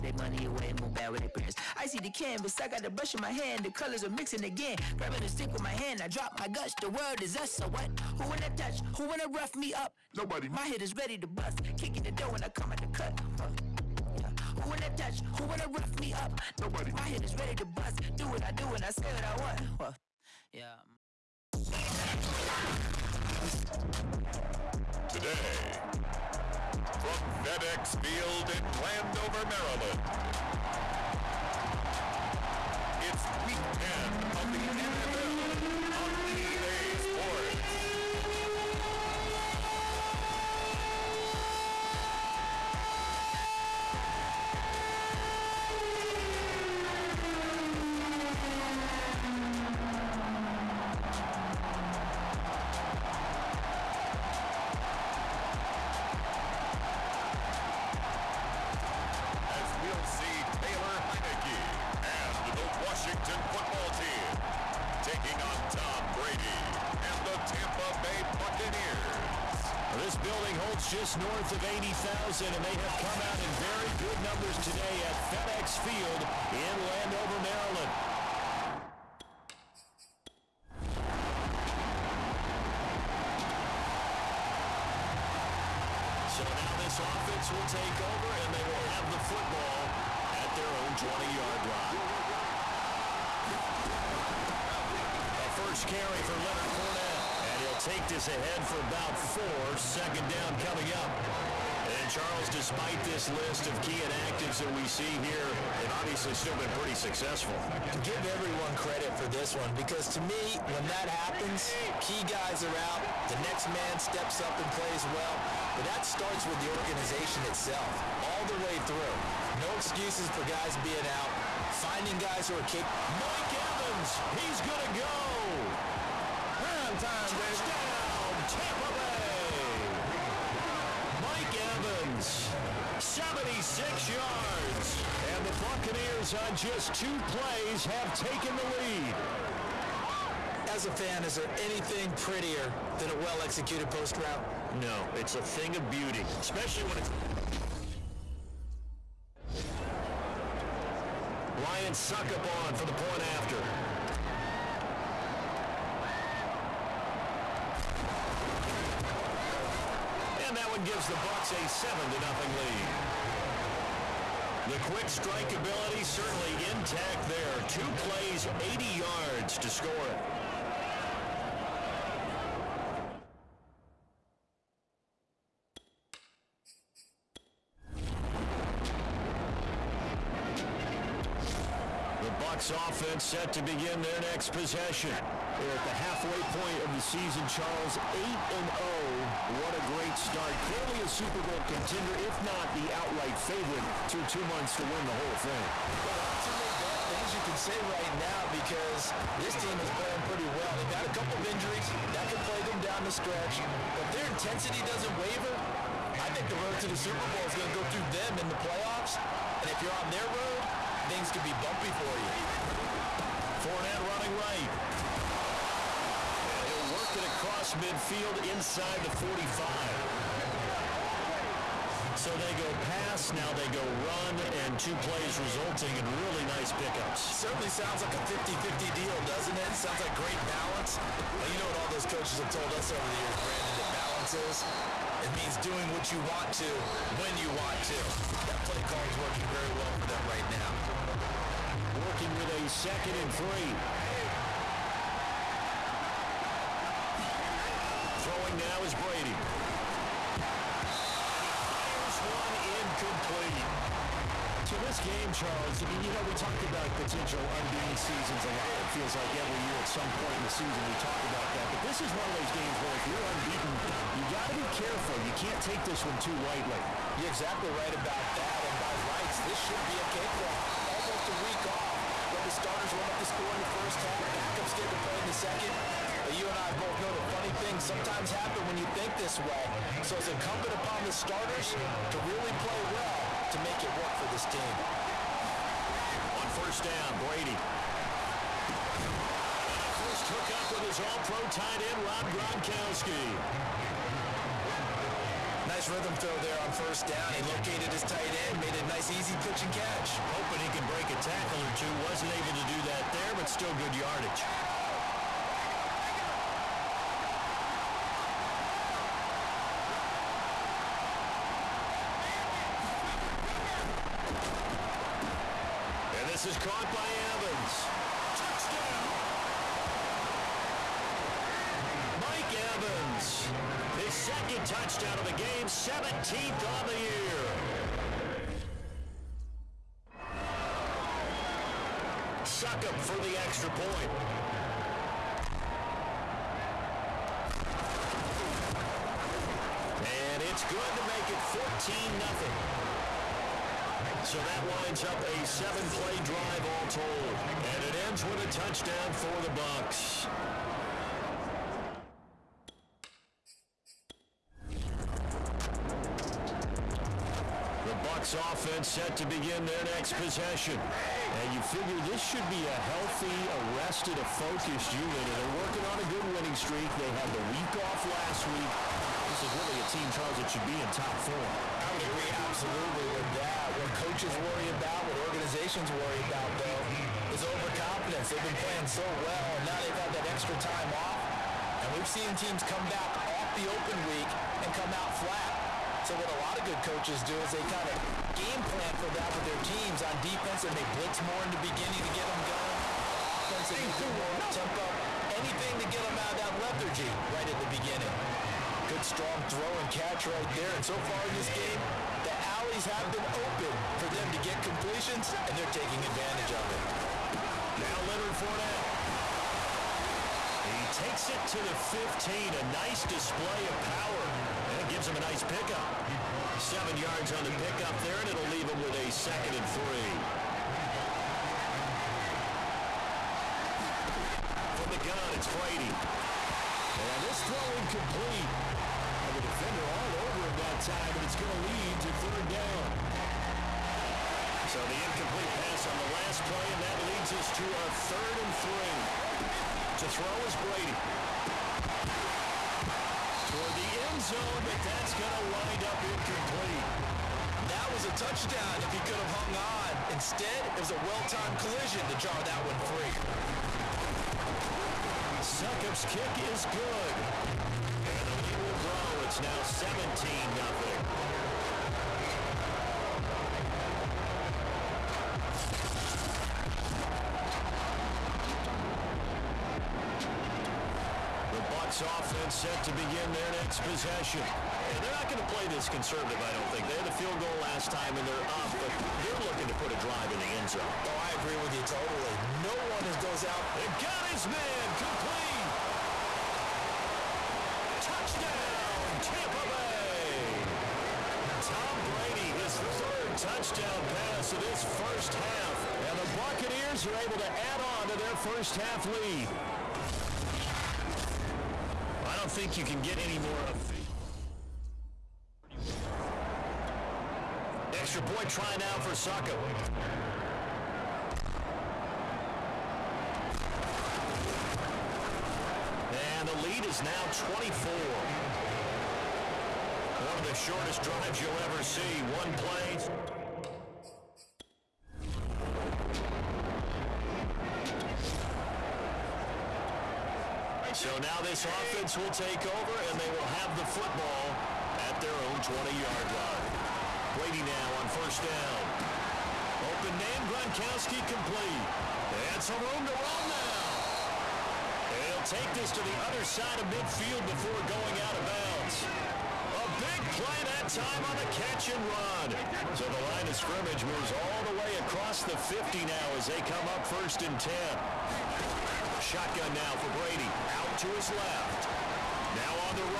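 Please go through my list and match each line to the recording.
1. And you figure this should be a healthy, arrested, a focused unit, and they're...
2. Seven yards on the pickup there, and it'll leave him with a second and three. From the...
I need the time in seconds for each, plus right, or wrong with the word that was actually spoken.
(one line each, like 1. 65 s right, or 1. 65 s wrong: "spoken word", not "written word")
1. 361 s right
2. 416 s right.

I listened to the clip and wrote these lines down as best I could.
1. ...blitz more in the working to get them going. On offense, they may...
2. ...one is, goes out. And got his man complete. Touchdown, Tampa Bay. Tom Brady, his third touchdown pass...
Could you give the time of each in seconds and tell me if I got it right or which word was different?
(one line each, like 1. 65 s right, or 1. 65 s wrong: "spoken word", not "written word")
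1. 390 s wrong: "beginning", not "working"
2. 482 s right.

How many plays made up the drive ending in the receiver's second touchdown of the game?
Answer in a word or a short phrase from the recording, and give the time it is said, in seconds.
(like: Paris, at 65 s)
7, at 345 s.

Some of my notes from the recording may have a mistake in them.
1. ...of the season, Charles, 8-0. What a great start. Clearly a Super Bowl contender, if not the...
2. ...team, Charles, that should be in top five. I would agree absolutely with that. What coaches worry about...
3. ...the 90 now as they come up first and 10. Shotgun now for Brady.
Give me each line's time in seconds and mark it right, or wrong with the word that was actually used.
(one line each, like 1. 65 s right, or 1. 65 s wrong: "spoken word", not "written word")
1. 186 s right
2. 369 s wrong: "four", not "five"
3. 555 s wrong: "50", not "90".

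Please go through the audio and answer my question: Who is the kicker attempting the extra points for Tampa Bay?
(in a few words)
Ryan Succop.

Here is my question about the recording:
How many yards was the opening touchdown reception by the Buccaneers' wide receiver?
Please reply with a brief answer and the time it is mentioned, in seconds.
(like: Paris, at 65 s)
76, at 132 s.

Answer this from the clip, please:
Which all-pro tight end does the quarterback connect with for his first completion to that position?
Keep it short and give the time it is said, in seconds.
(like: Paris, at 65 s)
Rob Gronkowski, at 292 s.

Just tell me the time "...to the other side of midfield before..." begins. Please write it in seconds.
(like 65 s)
545 s.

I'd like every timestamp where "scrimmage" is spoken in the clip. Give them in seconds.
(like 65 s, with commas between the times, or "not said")
553 s.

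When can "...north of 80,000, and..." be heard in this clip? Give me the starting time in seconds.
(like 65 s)
71 s.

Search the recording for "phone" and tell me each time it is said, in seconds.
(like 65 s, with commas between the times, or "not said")
not said.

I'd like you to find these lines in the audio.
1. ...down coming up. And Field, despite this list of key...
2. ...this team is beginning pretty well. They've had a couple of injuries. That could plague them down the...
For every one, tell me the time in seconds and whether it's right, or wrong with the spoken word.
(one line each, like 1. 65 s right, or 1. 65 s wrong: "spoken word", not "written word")
1. 100 s wrong: "Charles", not "Field"
2. 199 s wrong: "playing", not "beginning".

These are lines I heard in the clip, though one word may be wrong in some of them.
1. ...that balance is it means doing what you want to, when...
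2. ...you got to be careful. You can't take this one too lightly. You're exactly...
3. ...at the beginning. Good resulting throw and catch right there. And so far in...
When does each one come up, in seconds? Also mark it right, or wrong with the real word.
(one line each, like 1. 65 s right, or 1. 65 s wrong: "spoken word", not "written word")
1. 233 s right
2. 264 s right
3. 397 s wrong: "strong", not "resulting".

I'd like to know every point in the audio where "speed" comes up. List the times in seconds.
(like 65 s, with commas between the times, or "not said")
not said.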